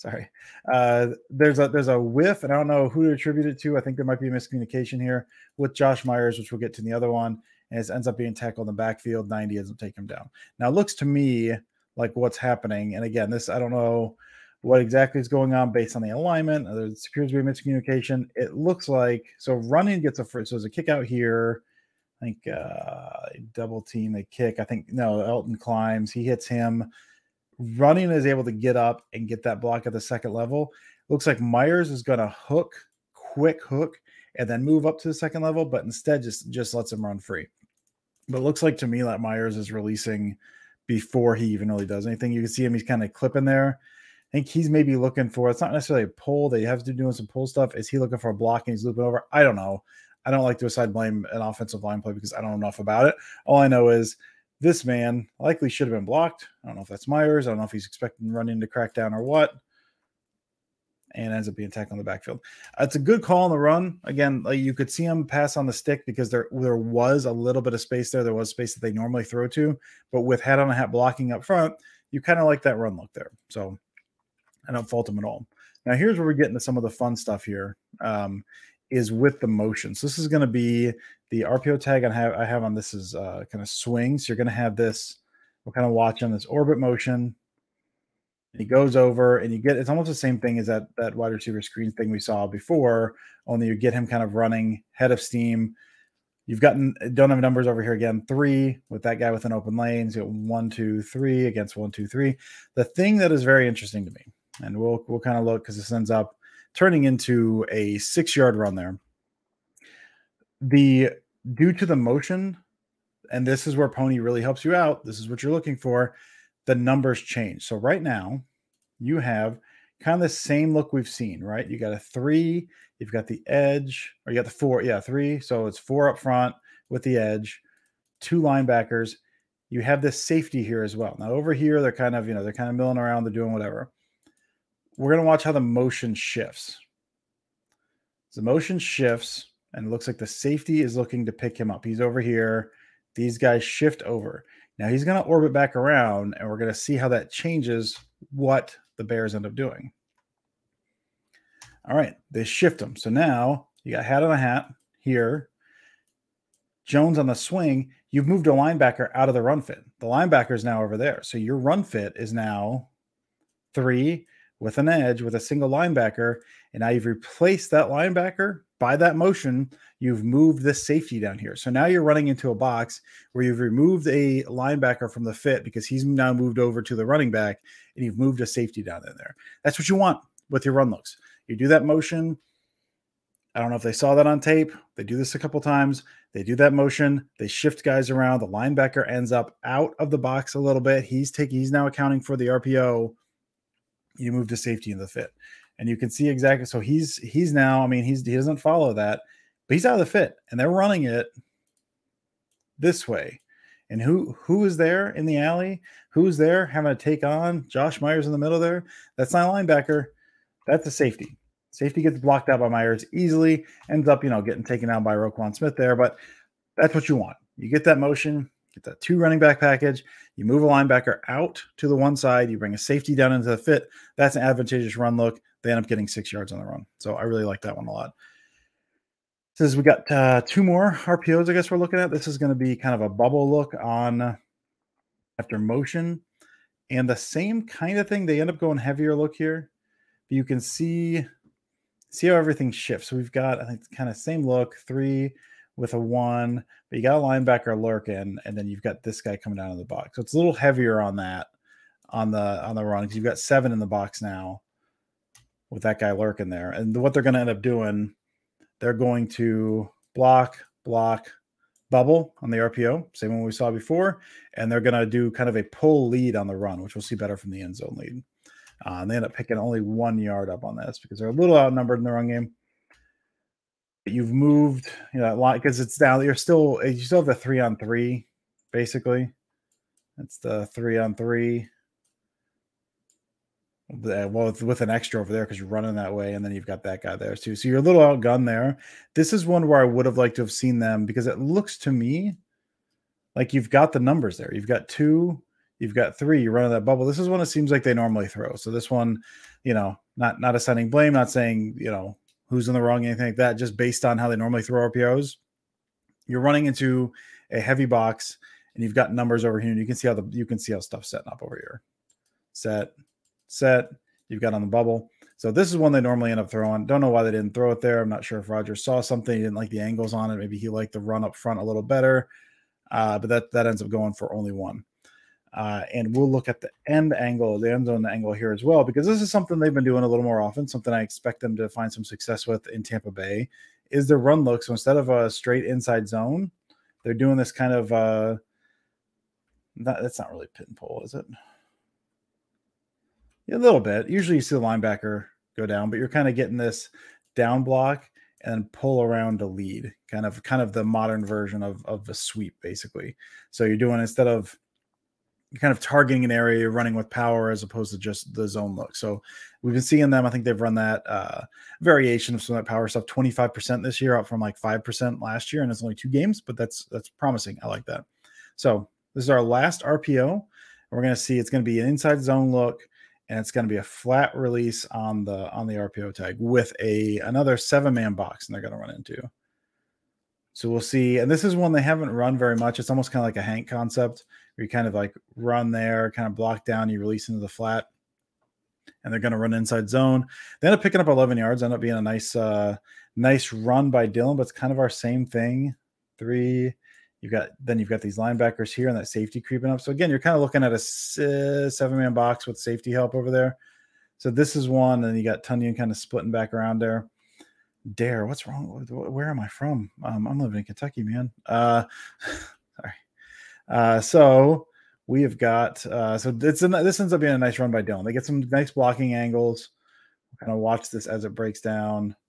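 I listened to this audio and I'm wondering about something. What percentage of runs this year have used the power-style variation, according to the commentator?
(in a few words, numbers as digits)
25%.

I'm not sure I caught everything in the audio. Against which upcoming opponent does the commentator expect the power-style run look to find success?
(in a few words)
Tampa Bay.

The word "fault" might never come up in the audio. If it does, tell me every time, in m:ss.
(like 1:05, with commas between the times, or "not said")
1:14.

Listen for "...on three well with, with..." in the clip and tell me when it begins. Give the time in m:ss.
4:40.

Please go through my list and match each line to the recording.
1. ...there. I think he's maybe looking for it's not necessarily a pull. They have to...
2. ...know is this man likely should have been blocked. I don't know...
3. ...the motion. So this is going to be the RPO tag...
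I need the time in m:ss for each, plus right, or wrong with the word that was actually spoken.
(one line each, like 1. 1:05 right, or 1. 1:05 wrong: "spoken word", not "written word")
1. 0:43 right
2. 0:53 right
3. 1:19 right.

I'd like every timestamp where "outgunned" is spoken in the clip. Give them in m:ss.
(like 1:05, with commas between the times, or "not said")
4:48.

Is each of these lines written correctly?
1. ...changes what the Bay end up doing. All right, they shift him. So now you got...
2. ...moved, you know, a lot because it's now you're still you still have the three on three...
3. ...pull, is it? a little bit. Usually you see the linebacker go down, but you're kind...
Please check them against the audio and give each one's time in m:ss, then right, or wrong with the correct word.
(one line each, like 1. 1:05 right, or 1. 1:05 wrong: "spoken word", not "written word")
1. 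2:27 wrong: "Bears", not "Bay"
2. 4:34 right
3. 5:40 right.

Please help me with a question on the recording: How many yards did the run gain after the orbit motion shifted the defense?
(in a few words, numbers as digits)
6.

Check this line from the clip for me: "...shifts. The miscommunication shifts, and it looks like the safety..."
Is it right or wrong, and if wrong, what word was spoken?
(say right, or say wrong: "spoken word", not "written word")
wrong: "motion", not "miscommunication".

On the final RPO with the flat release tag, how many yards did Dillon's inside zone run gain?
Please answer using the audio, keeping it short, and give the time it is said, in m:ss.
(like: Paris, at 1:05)
11, at 6:31.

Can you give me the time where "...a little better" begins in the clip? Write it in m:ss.
5:21.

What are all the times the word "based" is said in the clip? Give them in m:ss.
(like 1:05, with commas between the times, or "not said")
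0:15, 5:03.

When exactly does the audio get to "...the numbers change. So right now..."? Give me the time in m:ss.
1:56.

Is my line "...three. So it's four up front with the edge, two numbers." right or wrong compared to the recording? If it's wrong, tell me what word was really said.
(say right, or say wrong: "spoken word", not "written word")
wrong: "linebackers", not "numbers".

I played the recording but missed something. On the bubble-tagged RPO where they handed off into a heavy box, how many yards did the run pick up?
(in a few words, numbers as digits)
1.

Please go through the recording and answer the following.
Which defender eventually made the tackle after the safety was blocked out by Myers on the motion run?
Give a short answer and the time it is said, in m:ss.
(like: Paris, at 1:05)
Roquan Smith, at 3:35.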